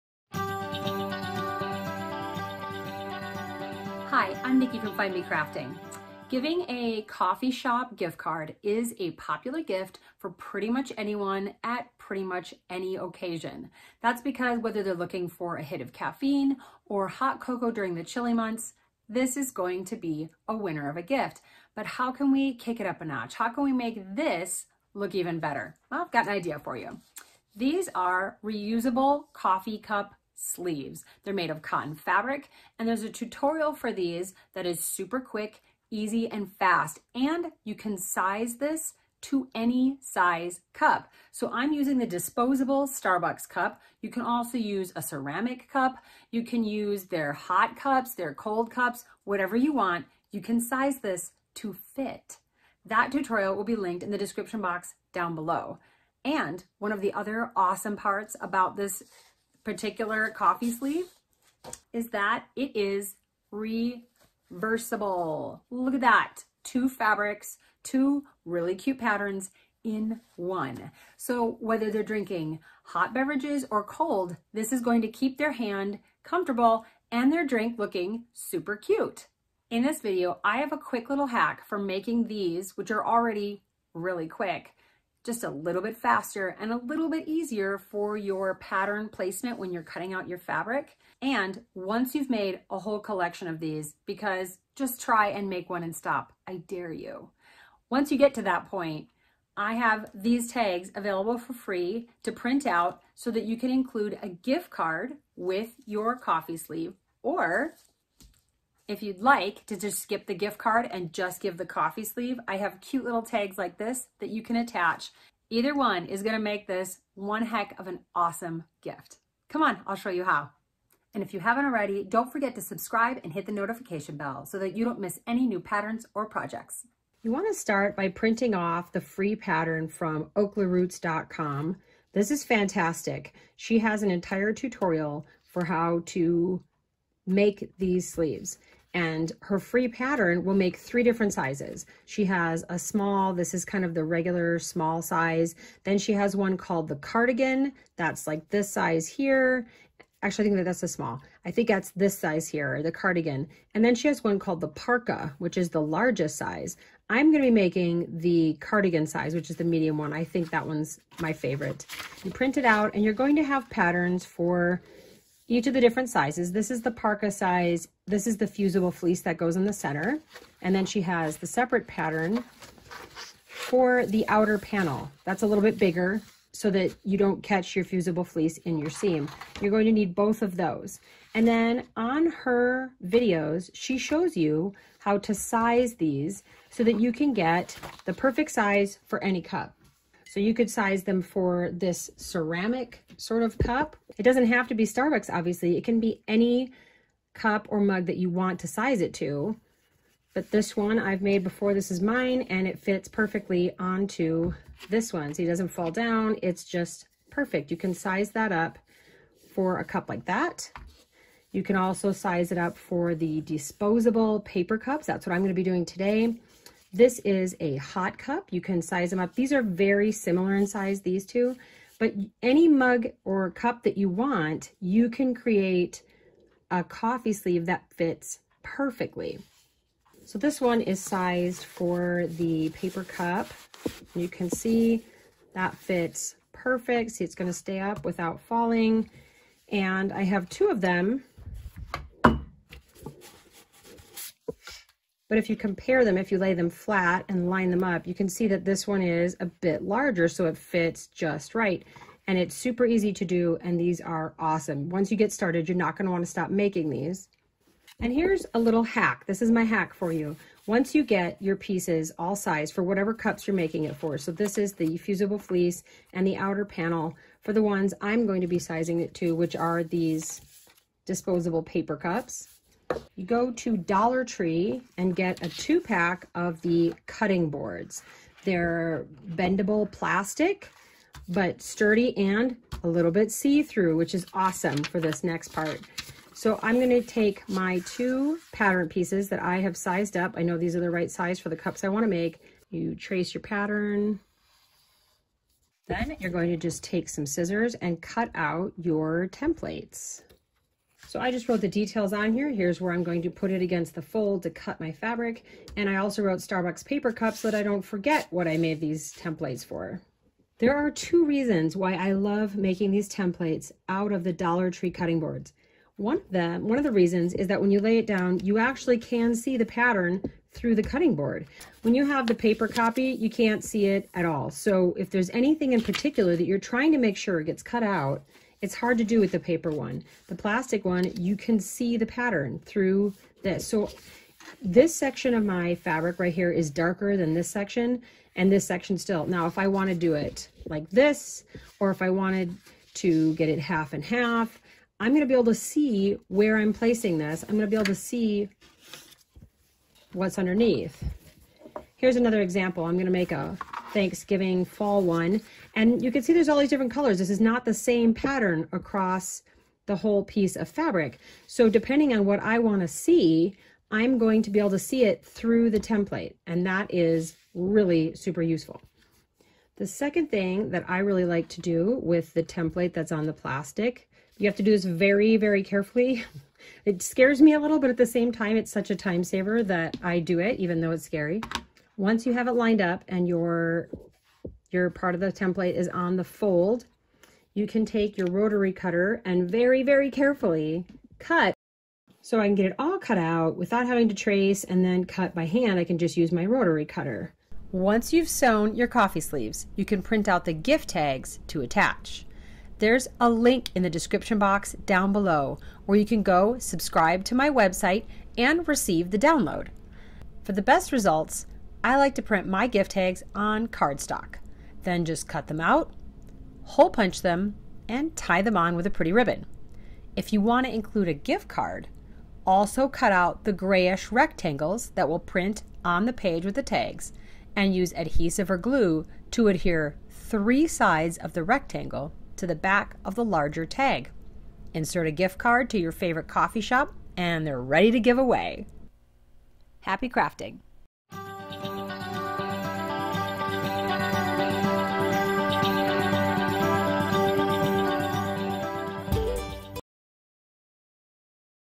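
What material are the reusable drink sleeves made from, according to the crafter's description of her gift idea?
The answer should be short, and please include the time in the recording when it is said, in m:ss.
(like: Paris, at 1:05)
Cotton fabric, at 0:31.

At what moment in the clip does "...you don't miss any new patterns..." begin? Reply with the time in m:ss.
2:04.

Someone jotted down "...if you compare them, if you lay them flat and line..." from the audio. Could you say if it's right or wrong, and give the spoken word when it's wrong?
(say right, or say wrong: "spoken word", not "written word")
right.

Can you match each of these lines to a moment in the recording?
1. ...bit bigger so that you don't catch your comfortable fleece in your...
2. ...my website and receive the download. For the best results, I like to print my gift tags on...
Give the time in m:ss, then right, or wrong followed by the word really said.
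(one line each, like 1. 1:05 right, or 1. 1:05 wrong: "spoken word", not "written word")
1. 2:55 wrong: "fusible", not "comfortable"
2. 6:47 right.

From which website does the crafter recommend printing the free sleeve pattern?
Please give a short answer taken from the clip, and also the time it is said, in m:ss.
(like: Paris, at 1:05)
Oklaroots.com, at 2:10.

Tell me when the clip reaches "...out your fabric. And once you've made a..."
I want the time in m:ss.
1:30.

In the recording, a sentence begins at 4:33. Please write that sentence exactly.
You go to Dollar Tree and get a two pack of the cutting boards.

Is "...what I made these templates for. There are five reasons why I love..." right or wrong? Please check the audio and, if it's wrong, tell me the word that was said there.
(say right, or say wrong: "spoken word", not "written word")
wrong: "two", not "five".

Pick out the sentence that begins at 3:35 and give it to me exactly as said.
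That's what I'm gonna be doing today.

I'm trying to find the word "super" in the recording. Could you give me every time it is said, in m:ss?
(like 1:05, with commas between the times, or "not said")
0:34, 1:18, 4:12, 6:08.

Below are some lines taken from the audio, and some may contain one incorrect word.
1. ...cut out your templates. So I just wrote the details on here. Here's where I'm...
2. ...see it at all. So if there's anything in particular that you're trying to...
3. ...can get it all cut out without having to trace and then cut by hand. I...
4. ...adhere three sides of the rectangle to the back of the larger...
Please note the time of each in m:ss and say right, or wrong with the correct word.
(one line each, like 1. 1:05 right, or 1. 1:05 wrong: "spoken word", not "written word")
1. 4:58 right
2. 5:23 right
3. 6:32 right
4. 7:09 right.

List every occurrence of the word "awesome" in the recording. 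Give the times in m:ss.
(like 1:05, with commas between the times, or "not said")
0:57, 1:58, 4:14, 4:44.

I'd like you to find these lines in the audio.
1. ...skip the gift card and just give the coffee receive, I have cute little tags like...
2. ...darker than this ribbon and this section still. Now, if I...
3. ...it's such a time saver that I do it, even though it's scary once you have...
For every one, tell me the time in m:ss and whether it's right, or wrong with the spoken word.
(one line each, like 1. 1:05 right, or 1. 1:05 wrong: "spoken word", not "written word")
1. 1:49 wrong: "sleeve", not "receive"
2. 5:36 wrong: "section", not "ribbon"
3. 6:18 right.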